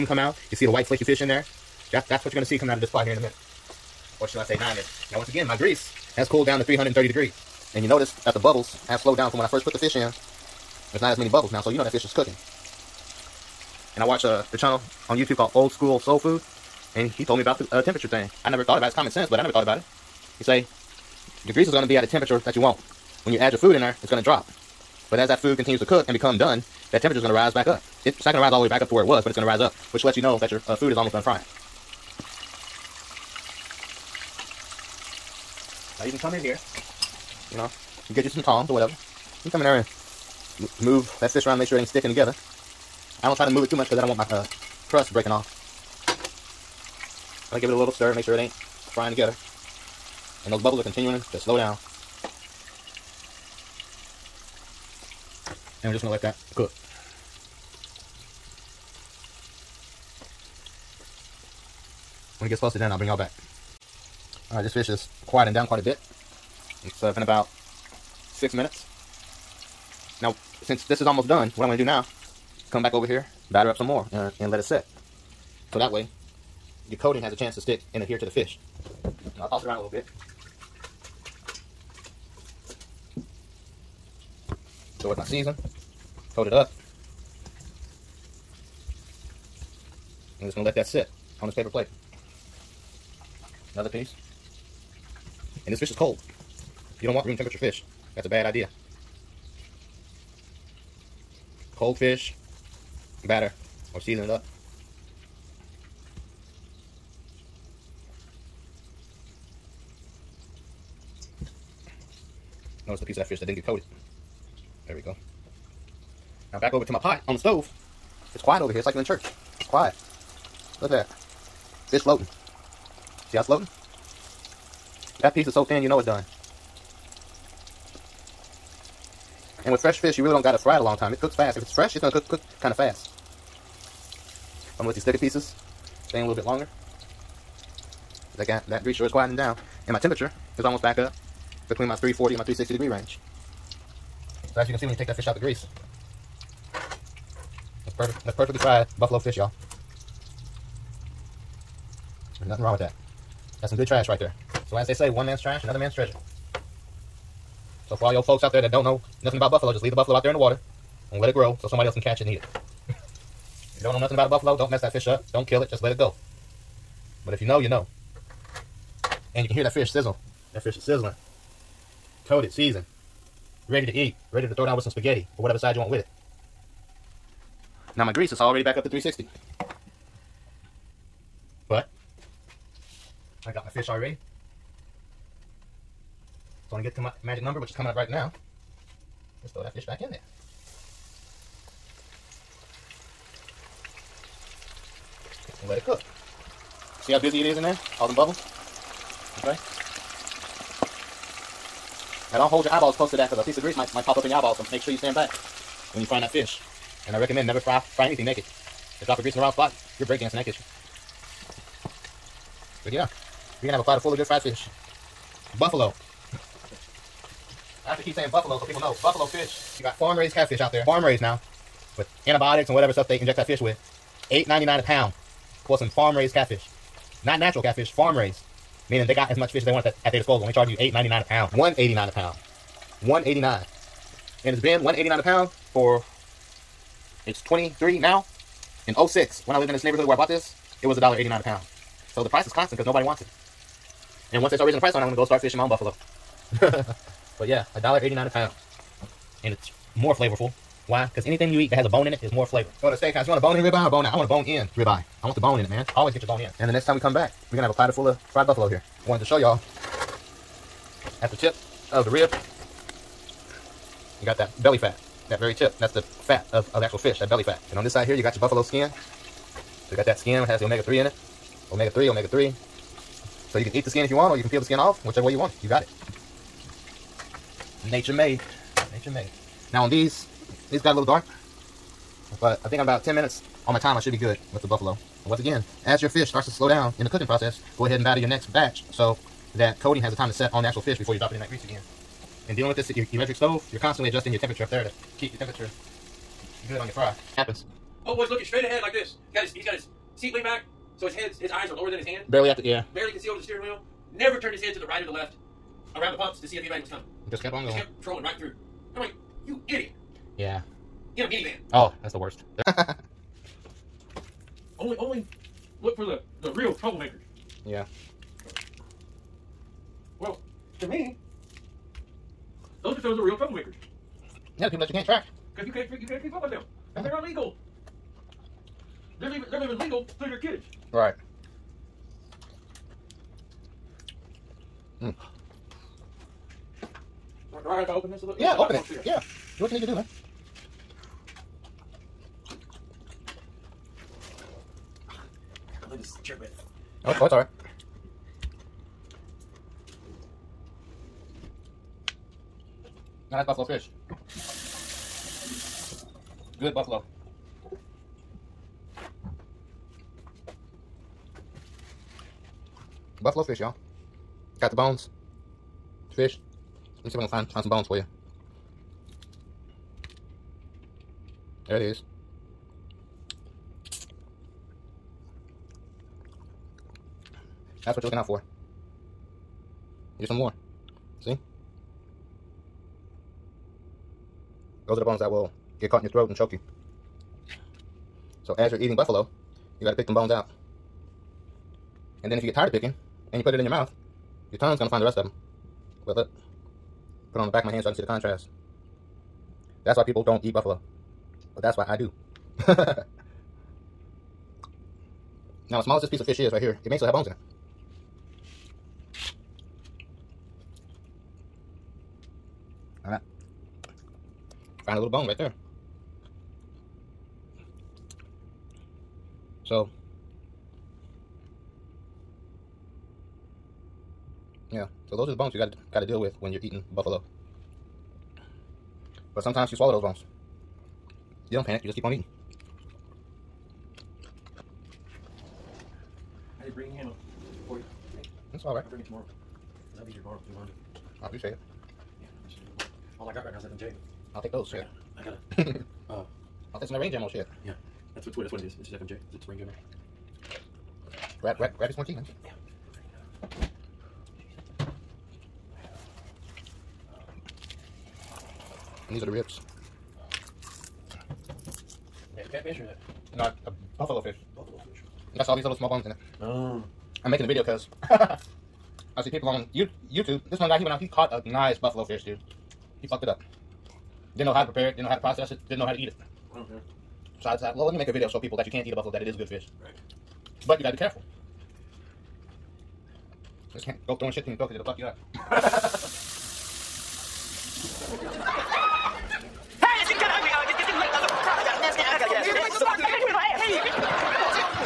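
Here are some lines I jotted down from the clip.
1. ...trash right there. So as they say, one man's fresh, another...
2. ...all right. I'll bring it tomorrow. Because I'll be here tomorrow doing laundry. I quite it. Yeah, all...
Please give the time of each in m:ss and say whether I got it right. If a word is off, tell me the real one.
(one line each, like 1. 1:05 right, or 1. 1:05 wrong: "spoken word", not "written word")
1. 2:33 wrong: "trash", not "fresh"
2. 7:18 wrong: "appreciate", not "quite".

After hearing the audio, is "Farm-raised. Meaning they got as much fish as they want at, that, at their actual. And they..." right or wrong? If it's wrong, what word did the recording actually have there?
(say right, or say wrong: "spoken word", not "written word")
wrong: "disposal", not "actual".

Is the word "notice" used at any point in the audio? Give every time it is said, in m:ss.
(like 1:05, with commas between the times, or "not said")
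0:07, 1:52.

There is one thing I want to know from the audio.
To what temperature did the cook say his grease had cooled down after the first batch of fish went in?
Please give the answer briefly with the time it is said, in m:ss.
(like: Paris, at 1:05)
330 degrees, at 0:06.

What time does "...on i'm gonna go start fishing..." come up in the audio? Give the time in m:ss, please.
4:04.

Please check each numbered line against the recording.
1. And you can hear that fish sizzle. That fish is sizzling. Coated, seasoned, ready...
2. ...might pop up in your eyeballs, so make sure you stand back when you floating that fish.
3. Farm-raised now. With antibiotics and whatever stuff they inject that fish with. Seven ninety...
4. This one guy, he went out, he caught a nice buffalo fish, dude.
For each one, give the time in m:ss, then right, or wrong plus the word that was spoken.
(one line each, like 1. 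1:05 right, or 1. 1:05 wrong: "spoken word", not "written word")
1. 2:49 right
2. 3:23 wrong: "frying", not "floating"
3. 3:40 wrong: "Eight", not "Seven"
4. 7:50 right.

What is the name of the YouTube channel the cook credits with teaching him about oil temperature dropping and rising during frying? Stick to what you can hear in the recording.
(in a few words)
Old School Soul Food.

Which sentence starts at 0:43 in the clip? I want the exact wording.
I don't try to move it too much because I don't want my uh, crust breaking off.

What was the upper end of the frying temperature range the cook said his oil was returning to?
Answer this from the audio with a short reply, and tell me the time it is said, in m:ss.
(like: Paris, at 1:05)
360 degrees, at 2:22.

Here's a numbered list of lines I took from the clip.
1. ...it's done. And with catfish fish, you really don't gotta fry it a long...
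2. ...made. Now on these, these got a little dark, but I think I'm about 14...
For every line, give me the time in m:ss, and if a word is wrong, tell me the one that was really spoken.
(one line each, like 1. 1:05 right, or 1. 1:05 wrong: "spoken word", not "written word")
1. 2:05 wrong: "fresh", not "catfish"
2. 4:39 wrong: "10", not "14".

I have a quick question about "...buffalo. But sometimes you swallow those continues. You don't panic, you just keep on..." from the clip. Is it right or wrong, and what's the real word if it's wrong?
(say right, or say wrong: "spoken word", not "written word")
wrong: "bones", not "continues".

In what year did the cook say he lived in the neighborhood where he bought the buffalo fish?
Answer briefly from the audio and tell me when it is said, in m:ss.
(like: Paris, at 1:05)
2006, at 3:58.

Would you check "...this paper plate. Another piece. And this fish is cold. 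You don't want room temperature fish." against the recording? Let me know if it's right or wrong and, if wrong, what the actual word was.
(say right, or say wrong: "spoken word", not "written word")
right.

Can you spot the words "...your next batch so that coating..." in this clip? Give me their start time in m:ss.
4:48.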